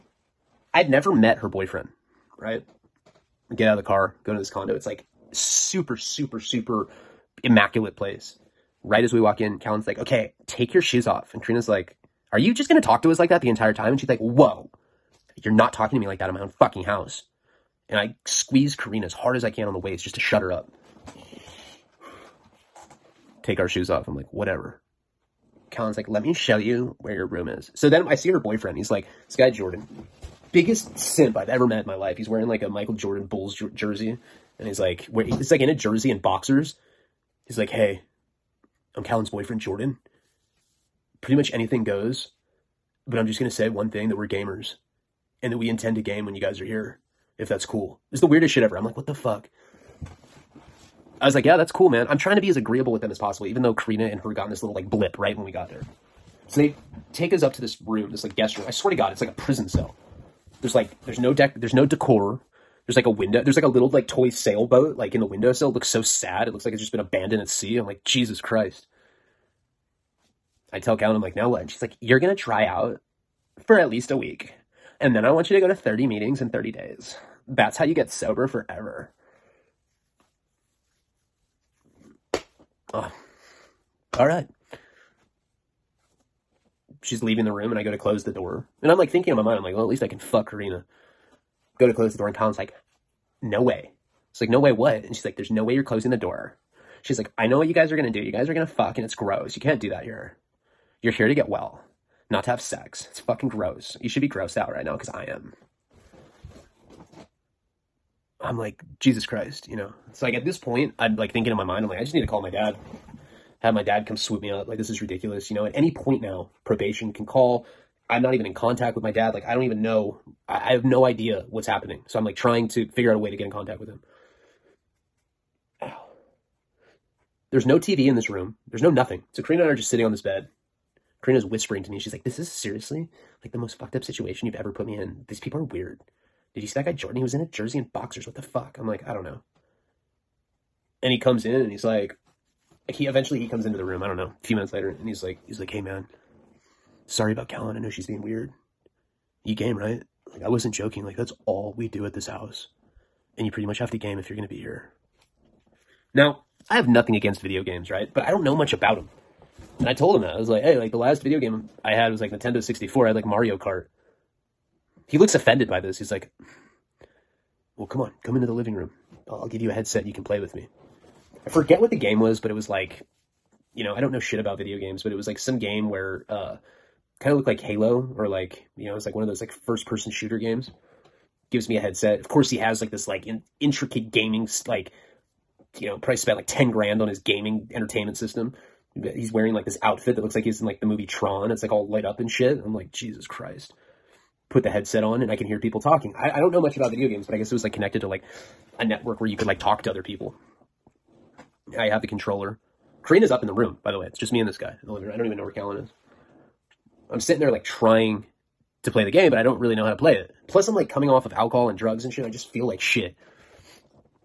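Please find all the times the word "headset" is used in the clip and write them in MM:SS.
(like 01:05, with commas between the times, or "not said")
02:49, 03:01, 03:14.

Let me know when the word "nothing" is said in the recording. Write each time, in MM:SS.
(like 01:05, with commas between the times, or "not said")
02:08, 02:36.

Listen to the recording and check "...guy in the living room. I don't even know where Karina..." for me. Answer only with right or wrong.
wrong.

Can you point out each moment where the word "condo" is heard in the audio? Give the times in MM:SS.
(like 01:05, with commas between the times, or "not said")
00:04.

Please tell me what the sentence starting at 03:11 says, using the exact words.
It's like all light up and shit.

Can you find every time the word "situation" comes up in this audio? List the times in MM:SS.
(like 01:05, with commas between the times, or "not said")
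02:14.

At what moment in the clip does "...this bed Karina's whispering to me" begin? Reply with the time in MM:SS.
02:10.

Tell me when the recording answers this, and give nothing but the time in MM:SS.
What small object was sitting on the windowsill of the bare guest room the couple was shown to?
01:04.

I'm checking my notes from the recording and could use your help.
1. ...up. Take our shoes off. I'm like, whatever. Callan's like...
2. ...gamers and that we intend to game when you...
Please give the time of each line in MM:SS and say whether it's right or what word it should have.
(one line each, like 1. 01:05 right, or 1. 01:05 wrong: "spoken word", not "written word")
1. 00:20 right
2. 00:44 right.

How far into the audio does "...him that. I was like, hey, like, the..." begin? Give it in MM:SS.
02:40.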